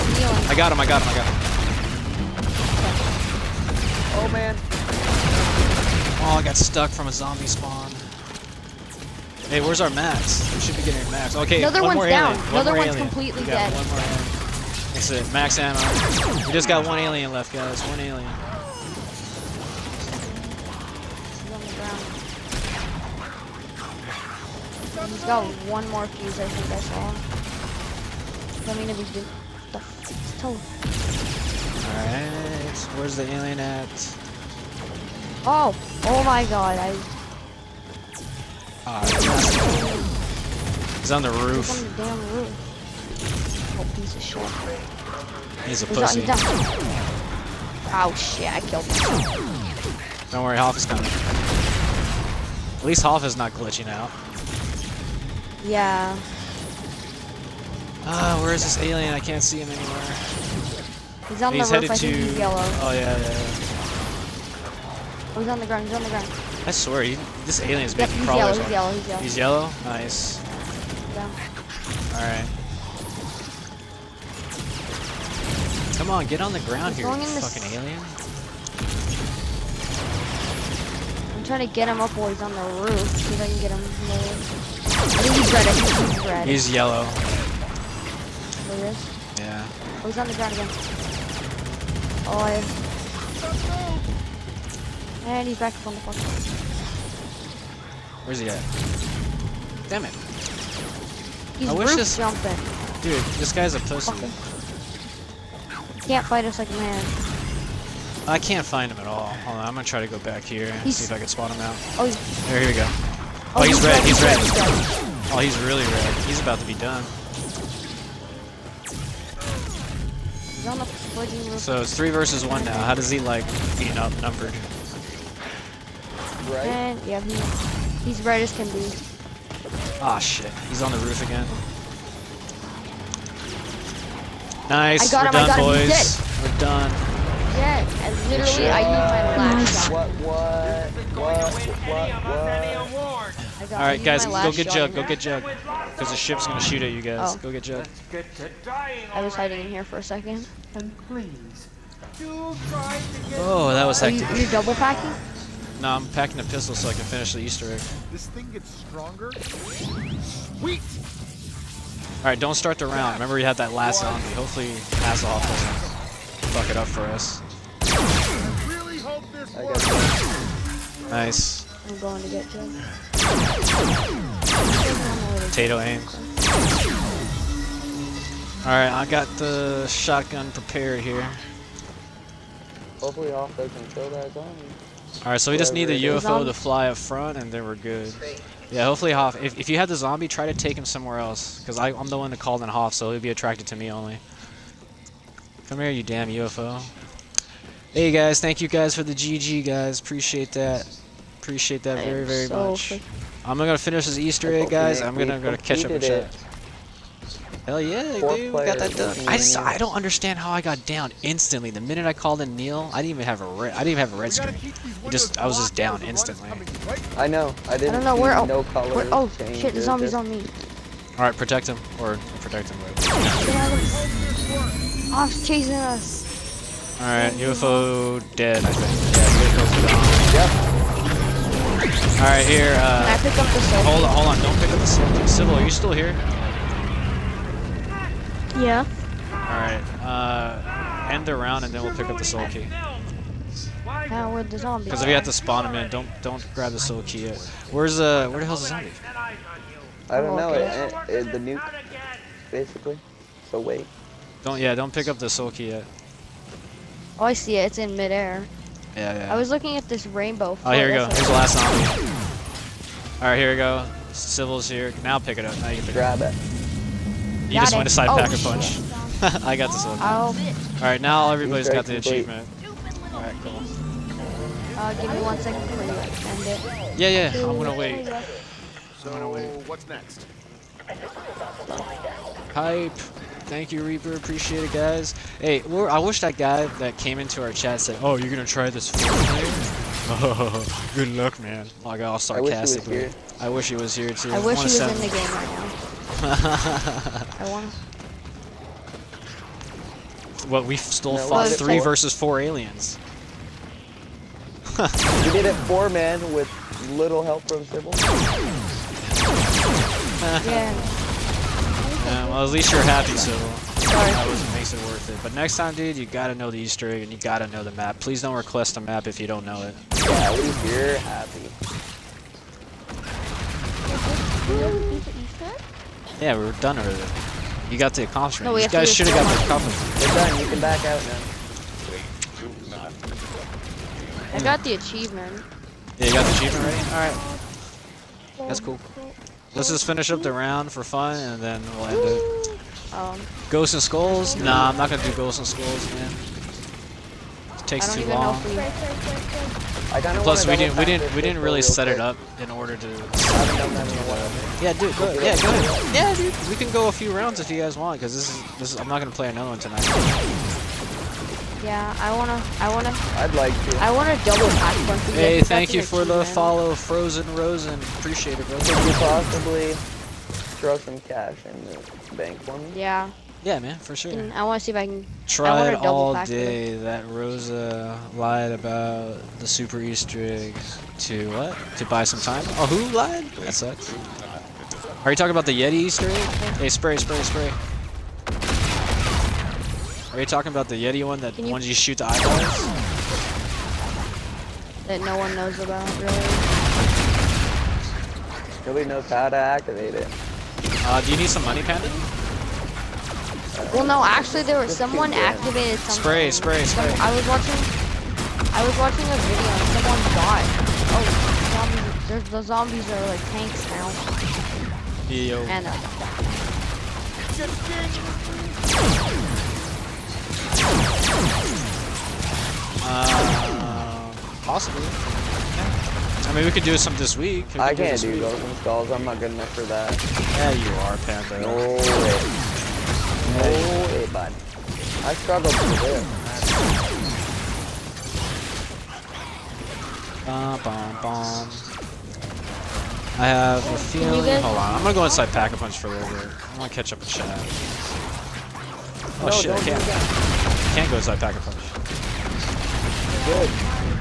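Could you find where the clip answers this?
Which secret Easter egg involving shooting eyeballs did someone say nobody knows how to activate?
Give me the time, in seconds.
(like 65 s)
385 s.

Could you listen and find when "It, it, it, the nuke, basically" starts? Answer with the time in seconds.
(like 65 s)
250 s.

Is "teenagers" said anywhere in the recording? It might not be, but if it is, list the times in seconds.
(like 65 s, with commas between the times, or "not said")
not said.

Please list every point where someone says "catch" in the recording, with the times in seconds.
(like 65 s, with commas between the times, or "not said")
205 s, 446 s.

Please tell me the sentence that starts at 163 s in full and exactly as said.
Remember you had that last zombie.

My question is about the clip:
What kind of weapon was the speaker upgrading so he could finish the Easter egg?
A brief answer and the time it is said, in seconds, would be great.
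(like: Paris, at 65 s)
a pistol, at 155 s.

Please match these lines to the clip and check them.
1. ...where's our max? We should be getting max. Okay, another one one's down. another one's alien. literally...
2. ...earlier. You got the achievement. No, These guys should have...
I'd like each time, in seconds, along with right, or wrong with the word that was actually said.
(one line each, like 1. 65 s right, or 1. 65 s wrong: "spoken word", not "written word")
1. 9 s wrong: "completely", not "literally"
2. 326 s wrong: "accomplishment", not "achievement".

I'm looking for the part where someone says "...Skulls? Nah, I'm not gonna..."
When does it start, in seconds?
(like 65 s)
343 s.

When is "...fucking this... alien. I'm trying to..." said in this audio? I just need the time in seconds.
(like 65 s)
77 s.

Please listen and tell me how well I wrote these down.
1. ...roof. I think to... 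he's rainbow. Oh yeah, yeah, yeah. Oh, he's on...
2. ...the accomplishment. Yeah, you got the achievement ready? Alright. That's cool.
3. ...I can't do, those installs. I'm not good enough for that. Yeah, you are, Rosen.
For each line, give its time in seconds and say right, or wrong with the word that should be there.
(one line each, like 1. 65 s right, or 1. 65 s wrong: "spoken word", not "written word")
1. 61 s wrong: "yellow", not "rainbow"
2. 334 s wrong: "achievement", not "accomplishment"
3. 427 s wrong: "Panther", not "Rosen".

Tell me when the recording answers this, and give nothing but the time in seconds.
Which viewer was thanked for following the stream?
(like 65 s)
366 s.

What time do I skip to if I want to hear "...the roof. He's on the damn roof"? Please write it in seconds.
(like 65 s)
41 s.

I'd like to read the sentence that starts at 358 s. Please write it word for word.
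Is, I'm not gonna play another one tonight.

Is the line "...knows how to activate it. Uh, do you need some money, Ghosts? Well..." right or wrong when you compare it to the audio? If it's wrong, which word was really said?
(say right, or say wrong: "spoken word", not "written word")
wrong: "Panda", not "Ghosts".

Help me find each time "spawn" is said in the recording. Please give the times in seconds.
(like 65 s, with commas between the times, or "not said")
7 s, 245 s.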